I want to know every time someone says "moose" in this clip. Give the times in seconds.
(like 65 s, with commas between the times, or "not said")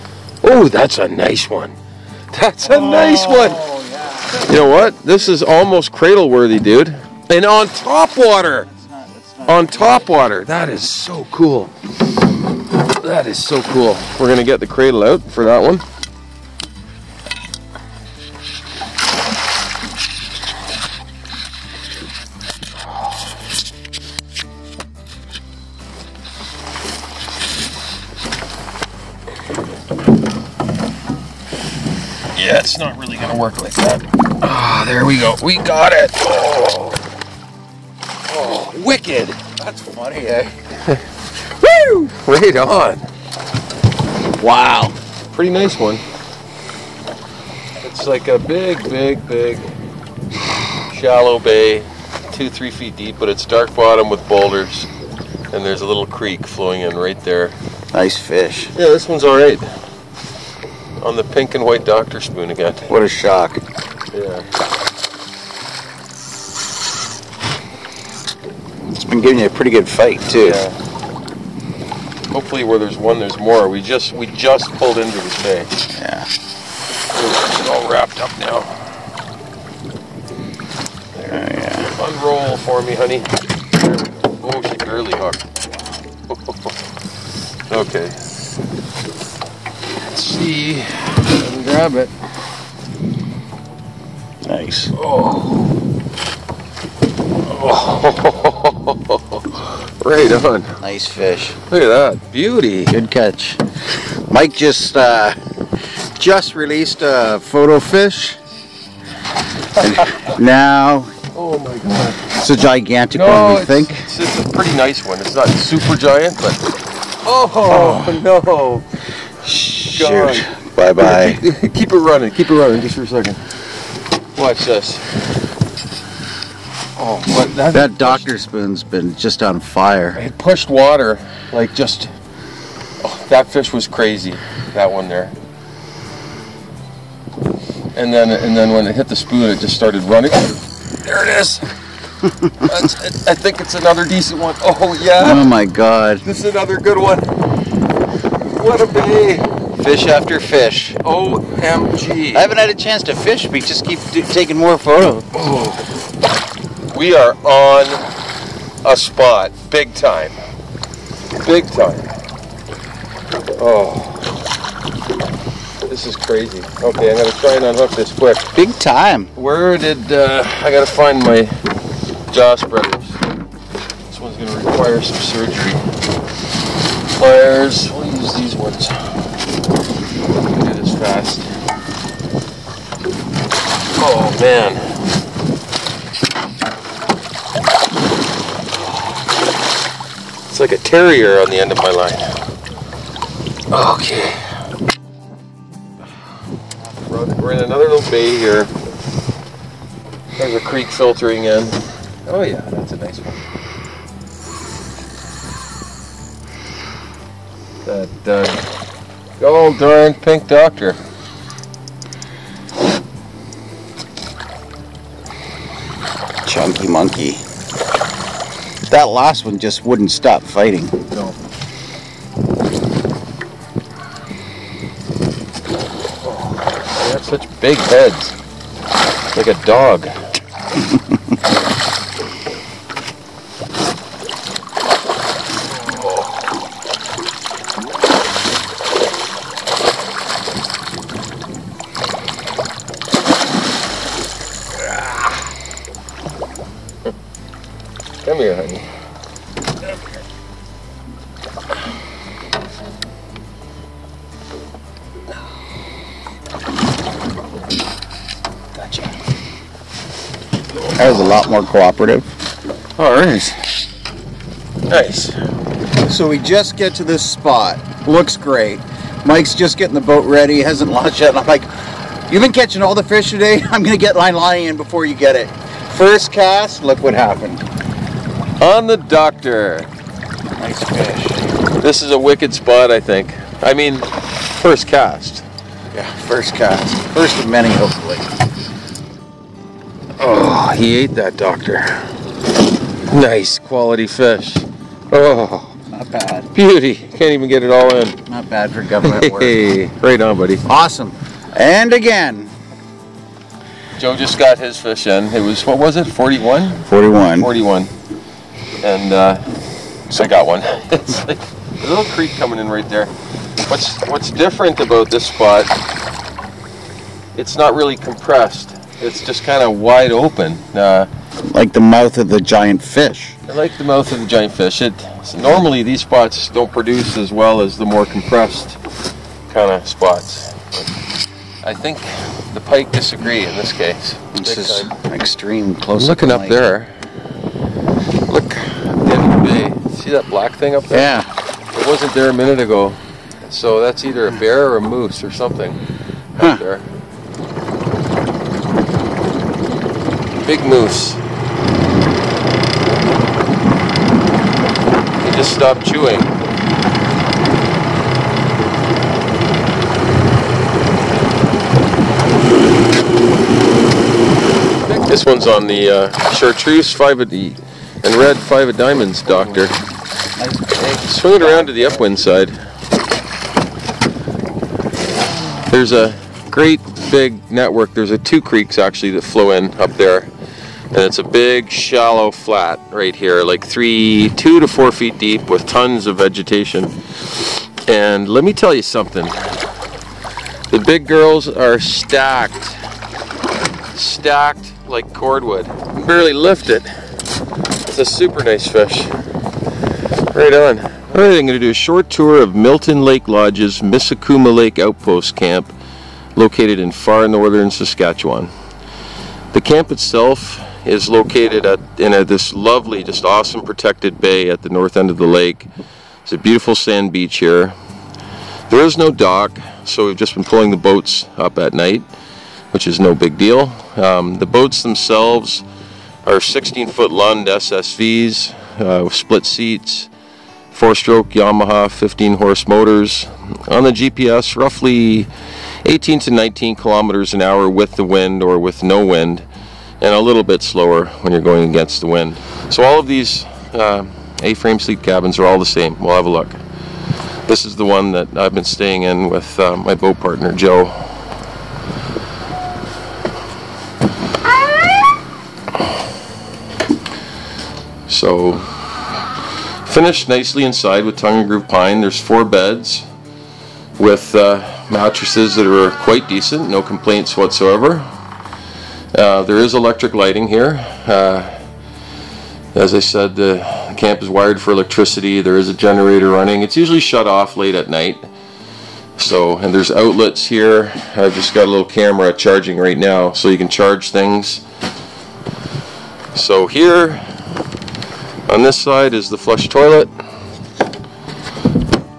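344 s, 350 s.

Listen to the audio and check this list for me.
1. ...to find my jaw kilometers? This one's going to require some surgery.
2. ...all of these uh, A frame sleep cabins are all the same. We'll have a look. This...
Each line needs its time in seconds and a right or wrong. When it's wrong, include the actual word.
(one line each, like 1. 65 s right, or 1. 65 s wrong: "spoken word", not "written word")
1. 170 s wrong: "spreaders", not "kilometers"
2. 442 s right.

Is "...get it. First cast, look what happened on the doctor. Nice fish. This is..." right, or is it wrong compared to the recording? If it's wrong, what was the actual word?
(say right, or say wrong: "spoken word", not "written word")
right.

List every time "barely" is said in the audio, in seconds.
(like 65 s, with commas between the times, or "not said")
84 s, 396 s.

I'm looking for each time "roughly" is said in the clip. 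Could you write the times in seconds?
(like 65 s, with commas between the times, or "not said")
434 s.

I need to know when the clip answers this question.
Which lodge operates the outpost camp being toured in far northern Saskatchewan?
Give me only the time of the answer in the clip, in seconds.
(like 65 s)
402 s.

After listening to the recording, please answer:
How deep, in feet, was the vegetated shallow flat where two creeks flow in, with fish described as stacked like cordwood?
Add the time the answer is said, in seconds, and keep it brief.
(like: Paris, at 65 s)
2 to 4 feet, at 384 s.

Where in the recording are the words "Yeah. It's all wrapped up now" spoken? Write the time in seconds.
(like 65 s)
75 s.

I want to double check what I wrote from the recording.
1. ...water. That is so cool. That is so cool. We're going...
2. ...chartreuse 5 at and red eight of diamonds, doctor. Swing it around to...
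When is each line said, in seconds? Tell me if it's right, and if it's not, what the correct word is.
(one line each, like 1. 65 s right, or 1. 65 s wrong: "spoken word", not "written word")
1. 10 s right
2. 366 s wrong: "five", not "eight".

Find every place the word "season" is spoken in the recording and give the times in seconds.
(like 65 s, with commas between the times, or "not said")
not said.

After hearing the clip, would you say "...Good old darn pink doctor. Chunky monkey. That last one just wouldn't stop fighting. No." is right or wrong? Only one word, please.
right.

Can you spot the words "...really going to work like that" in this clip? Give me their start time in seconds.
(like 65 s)
32 s.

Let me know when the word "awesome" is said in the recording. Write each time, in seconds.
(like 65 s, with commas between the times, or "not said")
300 s, 413 s.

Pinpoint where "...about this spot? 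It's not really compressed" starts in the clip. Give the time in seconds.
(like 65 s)
314 s.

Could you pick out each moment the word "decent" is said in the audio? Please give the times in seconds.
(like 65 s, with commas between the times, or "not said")
144 s, 466 s.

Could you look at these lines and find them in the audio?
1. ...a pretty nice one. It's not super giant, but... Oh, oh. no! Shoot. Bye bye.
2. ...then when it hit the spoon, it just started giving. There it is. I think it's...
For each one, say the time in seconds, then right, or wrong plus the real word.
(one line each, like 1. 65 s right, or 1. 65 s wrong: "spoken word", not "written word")
1. 114 s right
2. 138 s wrong: "running", not "giving".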